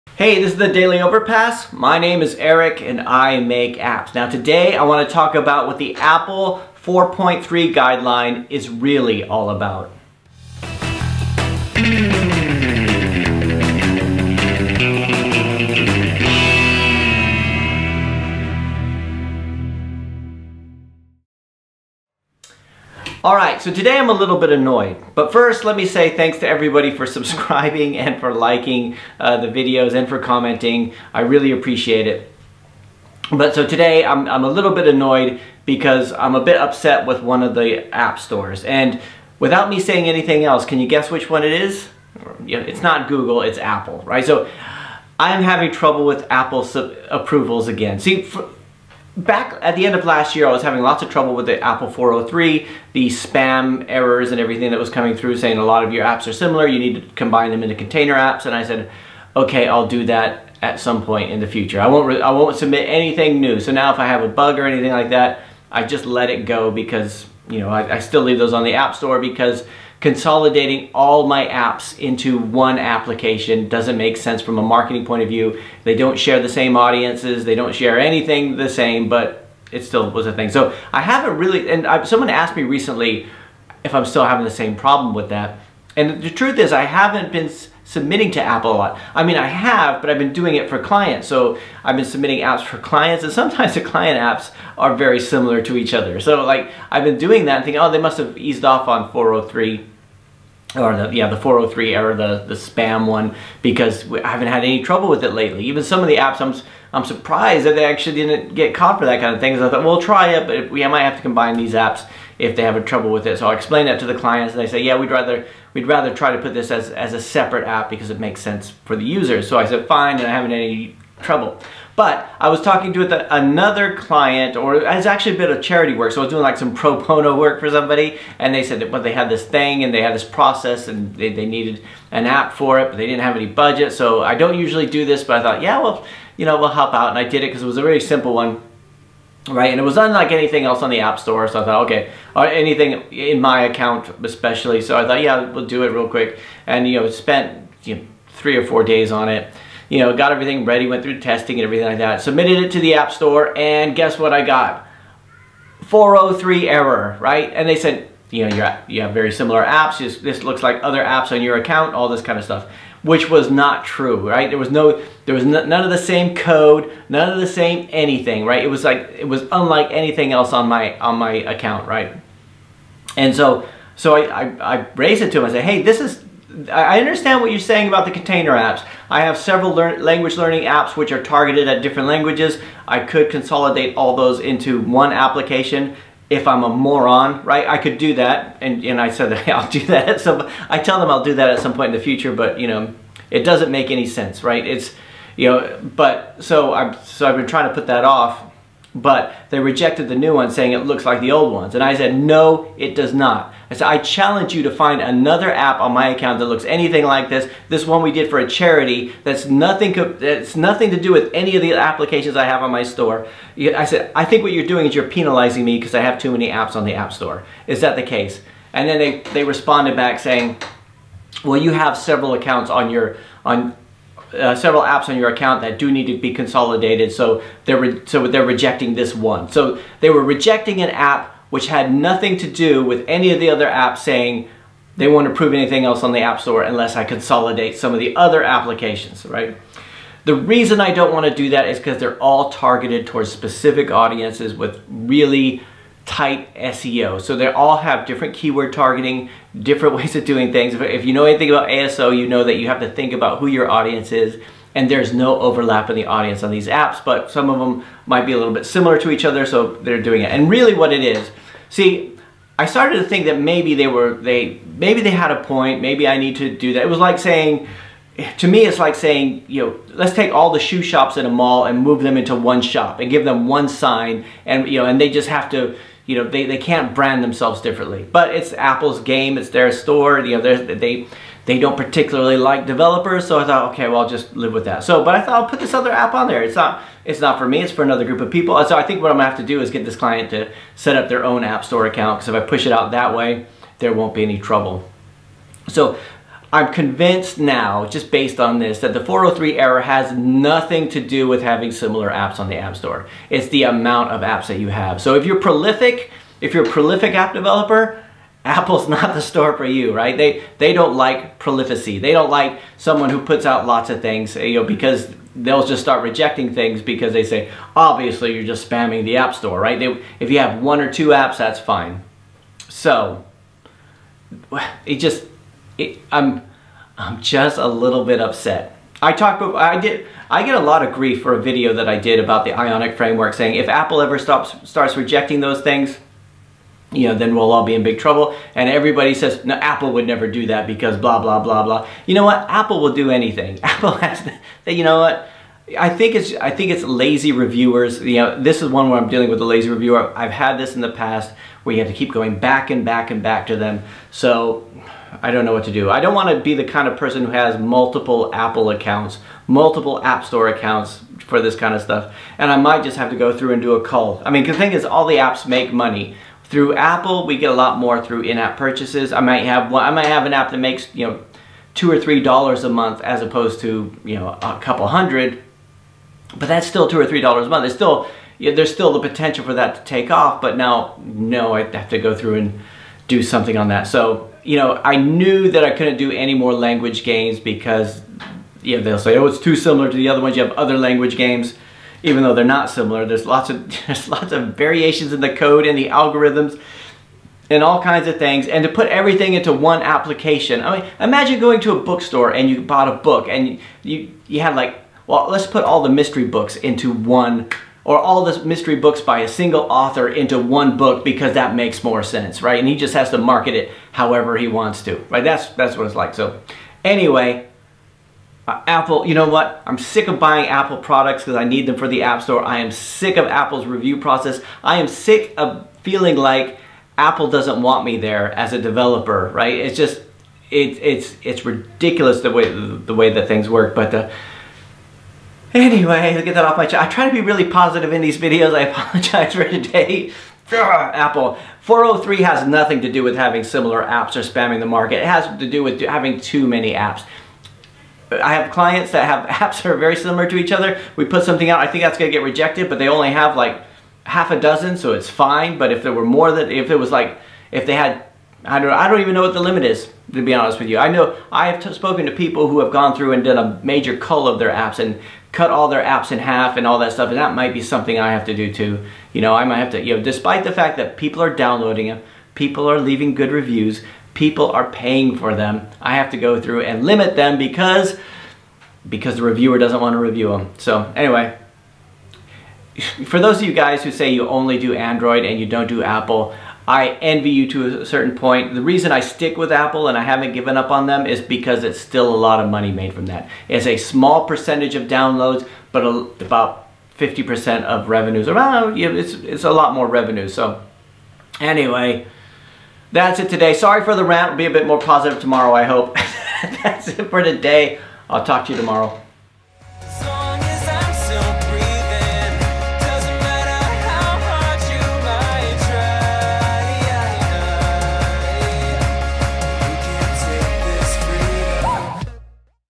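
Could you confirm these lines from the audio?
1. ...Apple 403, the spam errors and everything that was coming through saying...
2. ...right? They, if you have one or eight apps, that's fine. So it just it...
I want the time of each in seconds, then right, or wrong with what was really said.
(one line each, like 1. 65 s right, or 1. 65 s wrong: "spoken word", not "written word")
1. 51 s right
2. 319 s wrong: "two", not "eight".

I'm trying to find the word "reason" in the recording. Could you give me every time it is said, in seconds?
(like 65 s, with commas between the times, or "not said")
240 s, 488 s.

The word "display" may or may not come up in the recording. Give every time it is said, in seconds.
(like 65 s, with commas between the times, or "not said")
not said.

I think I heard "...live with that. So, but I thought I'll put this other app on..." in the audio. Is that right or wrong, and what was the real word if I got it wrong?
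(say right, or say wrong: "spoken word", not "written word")
right.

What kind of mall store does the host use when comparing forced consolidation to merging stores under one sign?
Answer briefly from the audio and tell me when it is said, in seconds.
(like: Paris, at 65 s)
shoe shops, at 270 s.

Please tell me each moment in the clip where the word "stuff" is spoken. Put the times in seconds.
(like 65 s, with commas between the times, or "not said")
162 s, 361 s, 466 s.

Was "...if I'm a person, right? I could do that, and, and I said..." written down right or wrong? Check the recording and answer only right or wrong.
wrong.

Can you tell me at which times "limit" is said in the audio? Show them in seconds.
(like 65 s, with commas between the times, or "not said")
459 s, 476 s.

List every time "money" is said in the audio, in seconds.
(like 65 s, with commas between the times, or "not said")
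365 s, 492 s.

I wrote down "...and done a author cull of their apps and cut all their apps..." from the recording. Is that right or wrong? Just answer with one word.
wrong.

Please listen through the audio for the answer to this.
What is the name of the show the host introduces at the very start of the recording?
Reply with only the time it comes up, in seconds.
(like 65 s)
0 s.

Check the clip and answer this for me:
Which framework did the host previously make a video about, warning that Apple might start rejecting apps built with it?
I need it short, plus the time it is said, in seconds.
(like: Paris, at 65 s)
Ionic, at 332 s.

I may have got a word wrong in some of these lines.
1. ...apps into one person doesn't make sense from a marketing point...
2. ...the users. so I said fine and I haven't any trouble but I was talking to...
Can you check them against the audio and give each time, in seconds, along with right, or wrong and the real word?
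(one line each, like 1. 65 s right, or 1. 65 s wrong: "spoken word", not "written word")
1. 71 s wrong: "application", not "person"
2. 118 s right.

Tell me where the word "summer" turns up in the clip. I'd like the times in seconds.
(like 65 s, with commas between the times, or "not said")
not said.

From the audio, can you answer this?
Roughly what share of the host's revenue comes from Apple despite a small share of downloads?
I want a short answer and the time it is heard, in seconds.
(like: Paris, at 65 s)
50%, at 496 s.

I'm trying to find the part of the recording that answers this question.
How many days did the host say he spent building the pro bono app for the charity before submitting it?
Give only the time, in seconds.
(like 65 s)
148 s.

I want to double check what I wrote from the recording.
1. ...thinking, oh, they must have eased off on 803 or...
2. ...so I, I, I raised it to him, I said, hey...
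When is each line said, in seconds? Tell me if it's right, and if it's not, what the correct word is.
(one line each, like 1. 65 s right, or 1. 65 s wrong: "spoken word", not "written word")
1. 97 s wrong: "403", not "803"
2. 173 s right.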